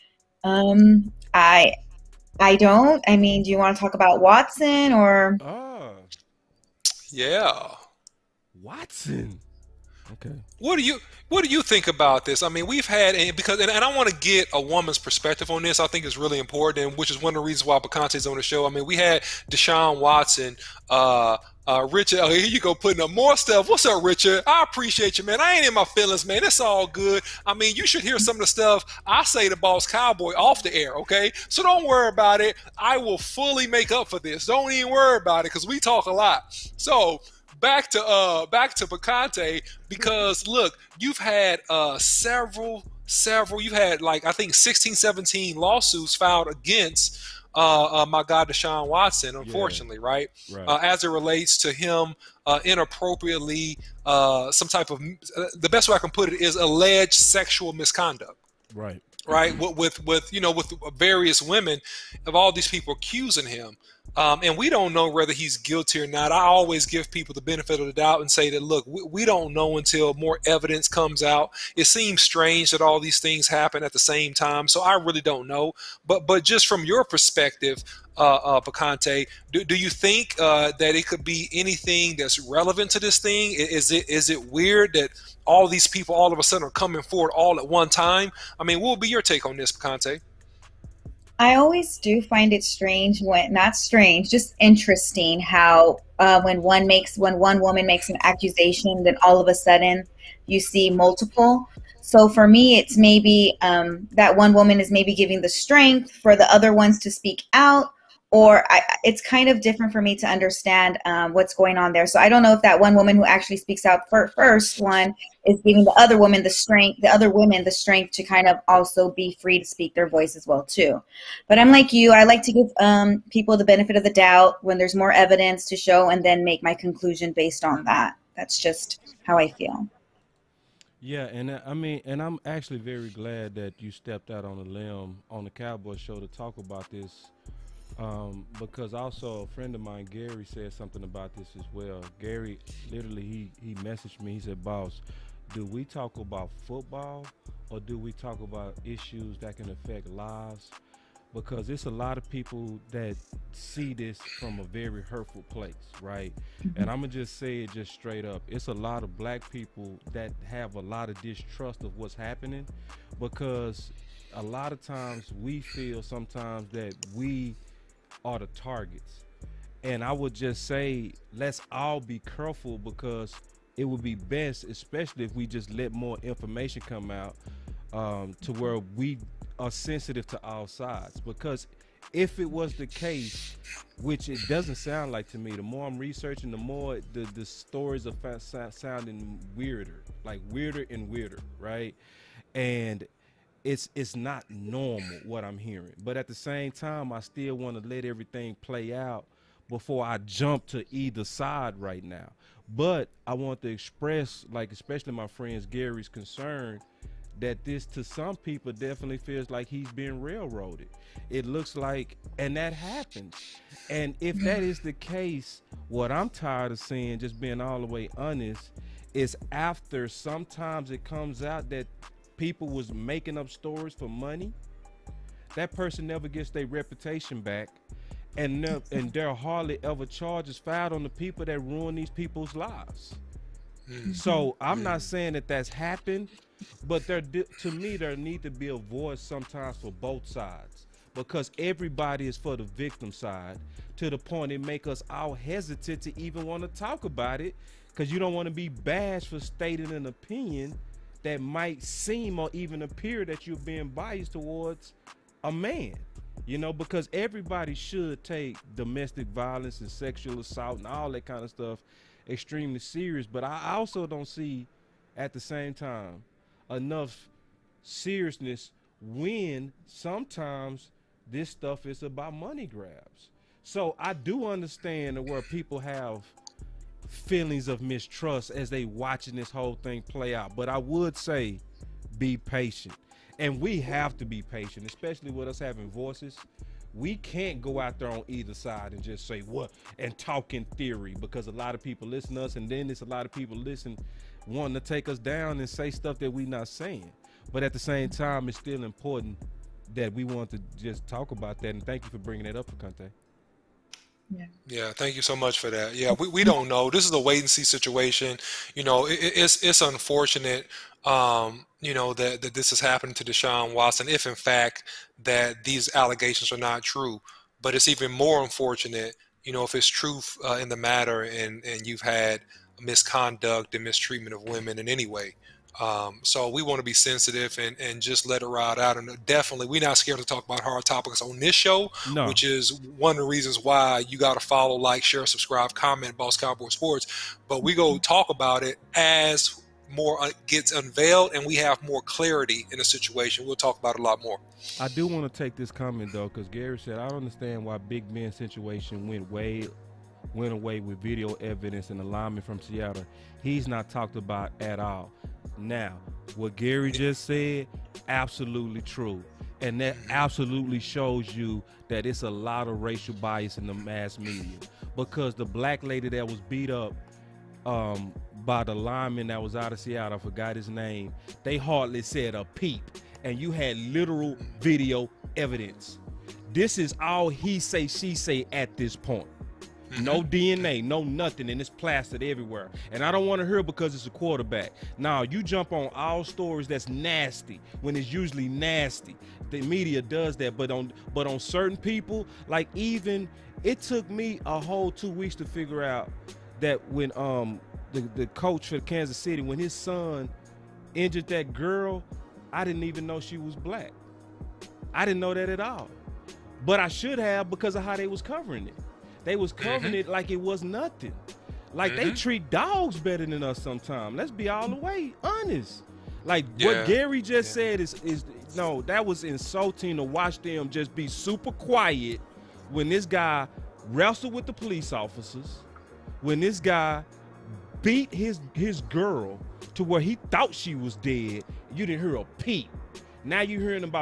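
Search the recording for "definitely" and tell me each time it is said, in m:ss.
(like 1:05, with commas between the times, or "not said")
3:28, 5:29.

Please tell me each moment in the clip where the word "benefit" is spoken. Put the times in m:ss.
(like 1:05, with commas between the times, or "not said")
1:07, 2:03.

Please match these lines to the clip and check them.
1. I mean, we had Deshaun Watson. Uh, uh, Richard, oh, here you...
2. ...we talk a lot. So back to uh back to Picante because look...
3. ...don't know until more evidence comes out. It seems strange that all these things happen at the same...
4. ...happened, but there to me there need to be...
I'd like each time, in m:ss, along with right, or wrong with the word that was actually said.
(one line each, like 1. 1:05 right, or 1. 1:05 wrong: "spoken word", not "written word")
1. 0:18 right
2. 0:35 right
3. 1:09 right
4. 3:55 right.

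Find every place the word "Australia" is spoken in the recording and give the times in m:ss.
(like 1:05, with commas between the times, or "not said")
not said.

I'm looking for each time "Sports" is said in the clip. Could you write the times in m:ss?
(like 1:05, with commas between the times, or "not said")
5:36.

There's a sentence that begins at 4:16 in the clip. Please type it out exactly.
You know, because everybody should take domestic violence and sexual assault and all that kind of stuff extremely serious.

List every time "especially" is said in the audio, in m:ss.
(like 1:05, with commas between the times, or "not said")
2:54, 3:24, 4:44.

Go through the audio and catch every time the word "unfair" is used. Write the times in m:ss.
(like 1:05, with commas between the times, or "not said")
not said.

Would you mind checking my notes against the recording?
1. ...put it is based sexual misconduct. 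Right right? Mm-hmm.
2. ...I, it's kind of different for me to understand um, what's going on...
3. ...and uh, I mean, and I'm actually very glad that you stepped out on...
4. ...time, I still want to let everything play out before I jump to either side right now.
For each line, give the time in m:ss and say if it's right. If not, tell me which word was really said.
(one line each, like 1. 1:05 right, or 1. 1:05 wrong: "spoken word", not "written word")
1. 0:56 wrong: "alleged", not "based"
2. 1:48 right
3. 2:11 right
4. 3:16 right.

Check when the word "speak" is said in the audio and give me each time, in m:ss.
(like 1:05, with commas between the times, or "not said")
1:47, 1:53, 1:59.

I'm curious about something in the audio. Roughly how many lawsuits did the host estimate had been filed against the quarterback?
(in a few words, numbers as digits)
16 17.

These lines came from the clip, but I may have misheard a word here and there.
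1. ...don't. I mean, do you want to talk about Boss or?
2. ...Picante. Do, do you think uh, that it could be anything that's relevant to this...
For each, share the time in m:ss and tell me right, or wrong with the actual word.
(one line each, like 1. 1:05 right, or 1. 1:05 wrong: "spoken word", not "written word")
1. 0:02 wrong: "Watson", not "Boss"
2. 1:18 right.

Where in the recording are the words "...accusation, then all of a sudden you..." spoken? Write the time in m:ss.
1:38.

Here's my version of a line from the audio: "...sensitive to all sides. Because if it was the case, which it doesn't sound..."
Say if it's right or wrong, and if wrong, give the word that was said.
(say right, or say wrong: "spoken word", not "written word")
right.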